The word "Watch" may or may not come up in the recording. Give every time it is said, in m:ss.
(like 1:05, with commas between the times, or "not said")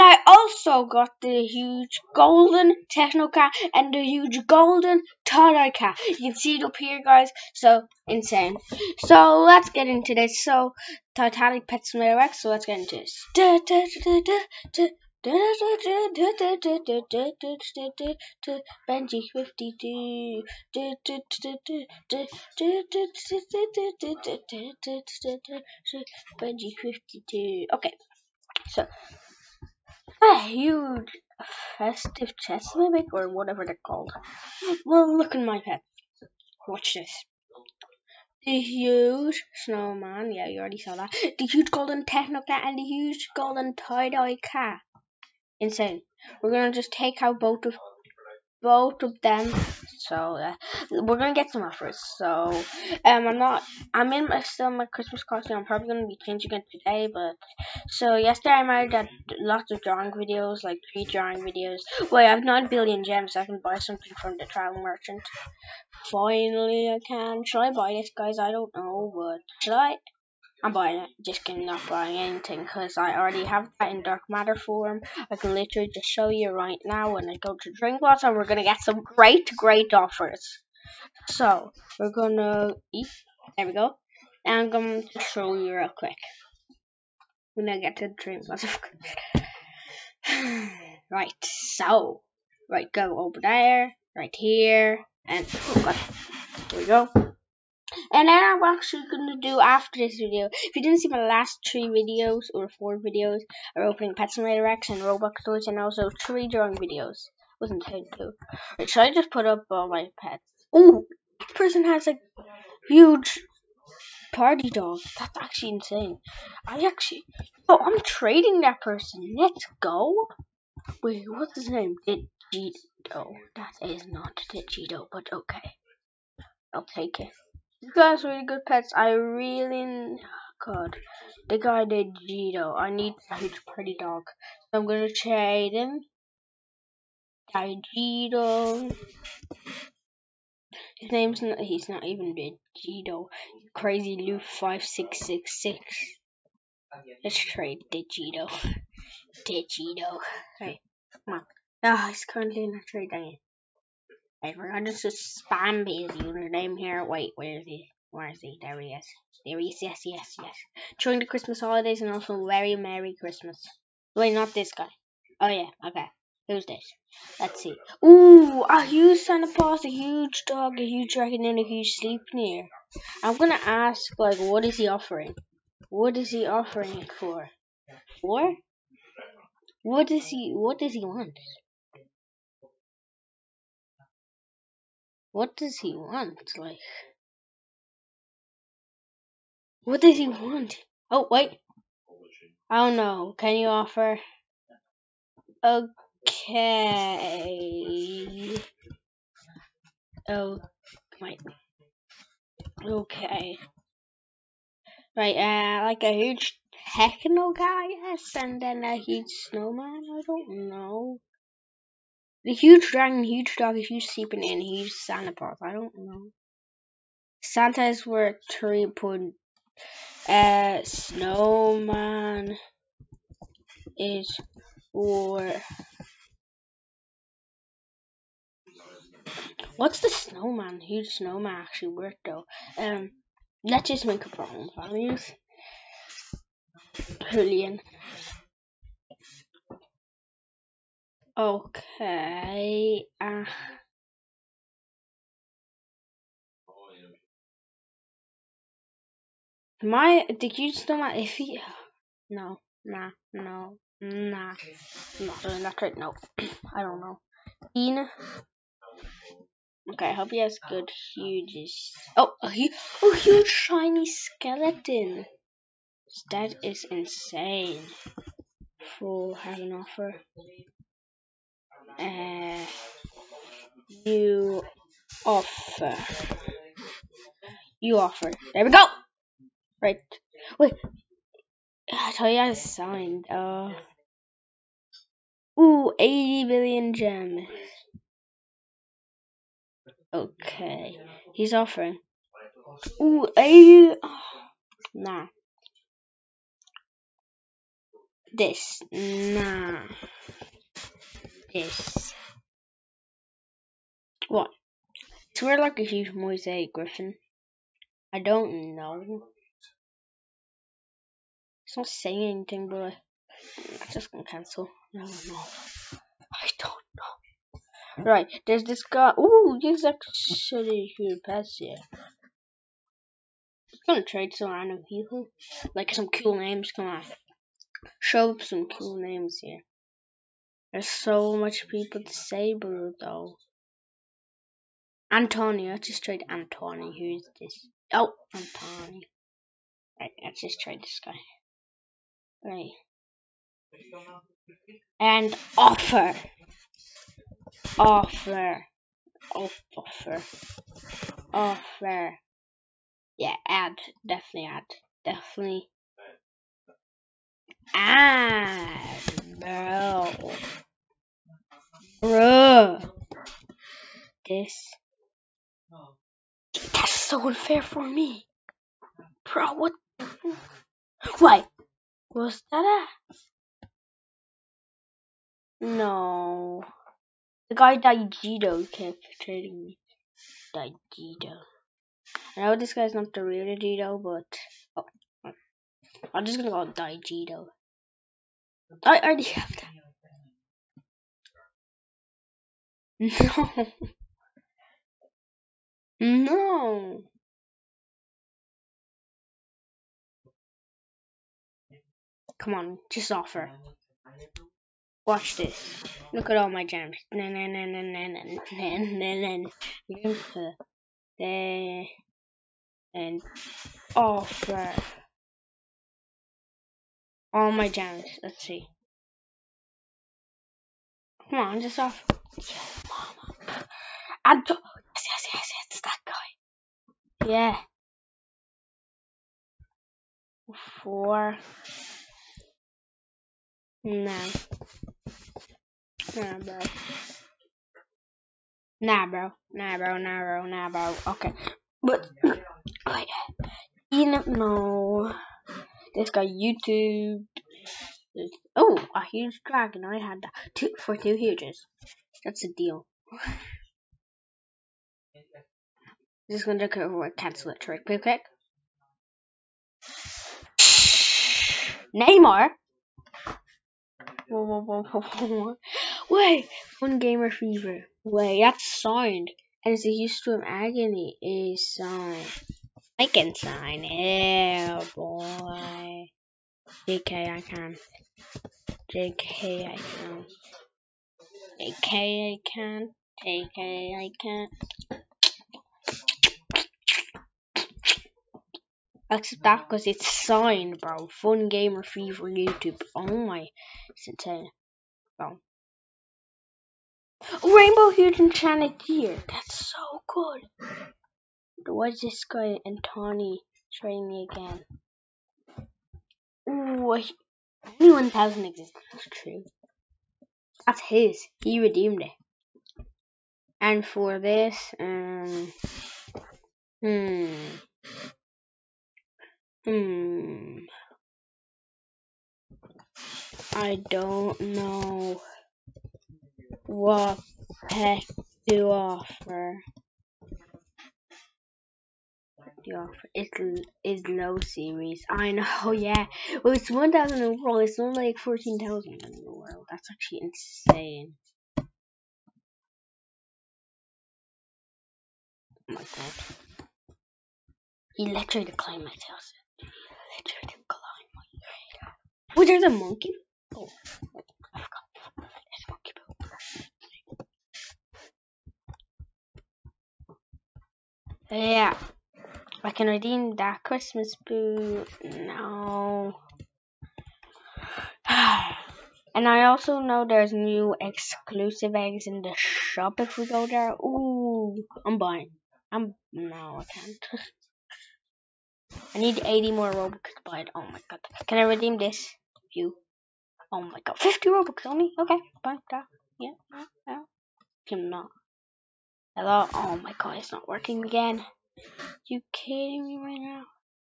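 0:36, 6:45.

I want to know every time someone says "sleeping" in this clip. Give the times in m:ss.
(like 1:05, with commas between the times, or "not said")
2:51.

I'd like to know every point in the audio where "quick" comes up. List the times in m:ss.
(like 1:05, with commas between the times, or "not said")
1:25, 7:37.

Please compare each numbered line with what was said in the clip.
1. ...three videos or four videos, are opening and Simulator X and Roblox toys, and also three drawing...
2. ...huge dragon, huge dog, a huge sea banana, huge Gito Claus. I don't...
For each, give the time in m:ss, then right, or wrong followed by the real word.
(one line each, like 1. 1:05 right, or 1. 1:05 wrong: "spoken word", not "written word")
1. 1:41 right
2. 3:32 wrong: "Santa", not "Gito".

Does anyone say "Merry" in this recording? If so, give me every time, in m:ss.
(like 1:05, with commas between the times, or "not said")
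2:42.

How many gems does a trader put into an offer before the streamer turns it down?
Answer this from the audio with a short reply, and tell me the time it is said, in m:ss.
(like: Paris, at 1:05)
80 billion, at 4:45.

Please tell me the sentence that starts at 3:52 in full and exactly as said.
Um, let's just make a problem values.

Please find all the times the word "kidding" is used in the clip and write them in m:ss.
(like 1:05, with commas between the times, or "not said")
1:11, 9:52.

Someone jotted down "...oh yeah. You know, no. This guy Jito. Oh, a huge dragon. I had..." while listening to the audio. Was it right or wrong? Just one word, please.
wrong.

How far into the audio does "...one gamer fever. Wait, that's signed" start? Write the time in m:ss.
7:46.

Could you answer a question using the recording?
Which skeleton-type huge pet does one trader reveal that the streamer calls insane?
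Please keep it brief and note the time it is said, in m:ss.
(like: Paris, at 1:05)
Huge shiny skeleton, at 4:23.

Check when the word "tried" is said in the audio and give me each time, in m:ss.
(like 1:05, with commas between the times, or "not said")
5:36, 5:40.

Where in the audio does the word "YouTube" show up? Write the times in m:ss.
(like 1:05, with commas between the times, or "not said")
7:26, 8:12.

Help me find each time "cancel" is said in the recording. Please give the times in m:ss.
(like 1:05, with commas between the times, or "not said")
5:14, 7:37.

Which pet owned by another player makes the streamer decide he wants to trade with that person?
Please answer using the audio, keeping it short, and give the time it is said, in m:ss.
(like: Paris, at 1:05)
Huge party dog, at 1:52.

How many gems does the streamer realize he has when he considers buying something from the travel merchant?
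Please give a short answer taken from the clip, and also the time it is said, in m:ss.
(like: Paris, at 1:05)
9 billion, at 1:02.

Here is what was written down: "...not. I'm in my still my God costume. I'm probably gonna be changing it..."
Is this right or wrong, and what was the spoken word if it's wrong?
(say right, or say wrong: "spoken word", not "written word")
wrong: "Christmas", not "God".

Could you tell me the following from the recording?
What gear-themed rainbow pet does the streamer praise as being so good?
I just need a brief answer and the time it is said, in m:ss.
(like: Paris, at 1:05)
Rainbow Huge Enchanted Gear, at 8:17.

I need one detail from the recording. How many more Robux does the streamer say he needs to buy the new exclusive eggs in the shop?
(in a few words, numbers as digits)
80.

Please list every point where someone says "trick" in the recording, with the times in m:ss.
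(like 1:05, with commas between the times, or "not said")
7:37.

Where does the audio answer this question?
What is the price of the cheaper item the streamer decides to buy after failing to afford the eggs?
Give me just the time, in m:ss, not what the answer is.
9:43.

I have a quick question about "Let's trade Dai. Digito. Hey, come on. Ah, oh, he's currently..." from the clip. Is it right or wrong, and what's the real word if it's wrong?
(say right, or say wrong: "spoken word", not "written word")
wrong: "Digito", not "Dai".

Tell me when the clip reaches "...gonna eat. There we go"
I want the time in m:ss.
1:22.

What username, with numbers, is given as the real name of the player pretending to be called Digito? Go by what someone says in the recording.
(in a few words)
Crazy Lou 5666.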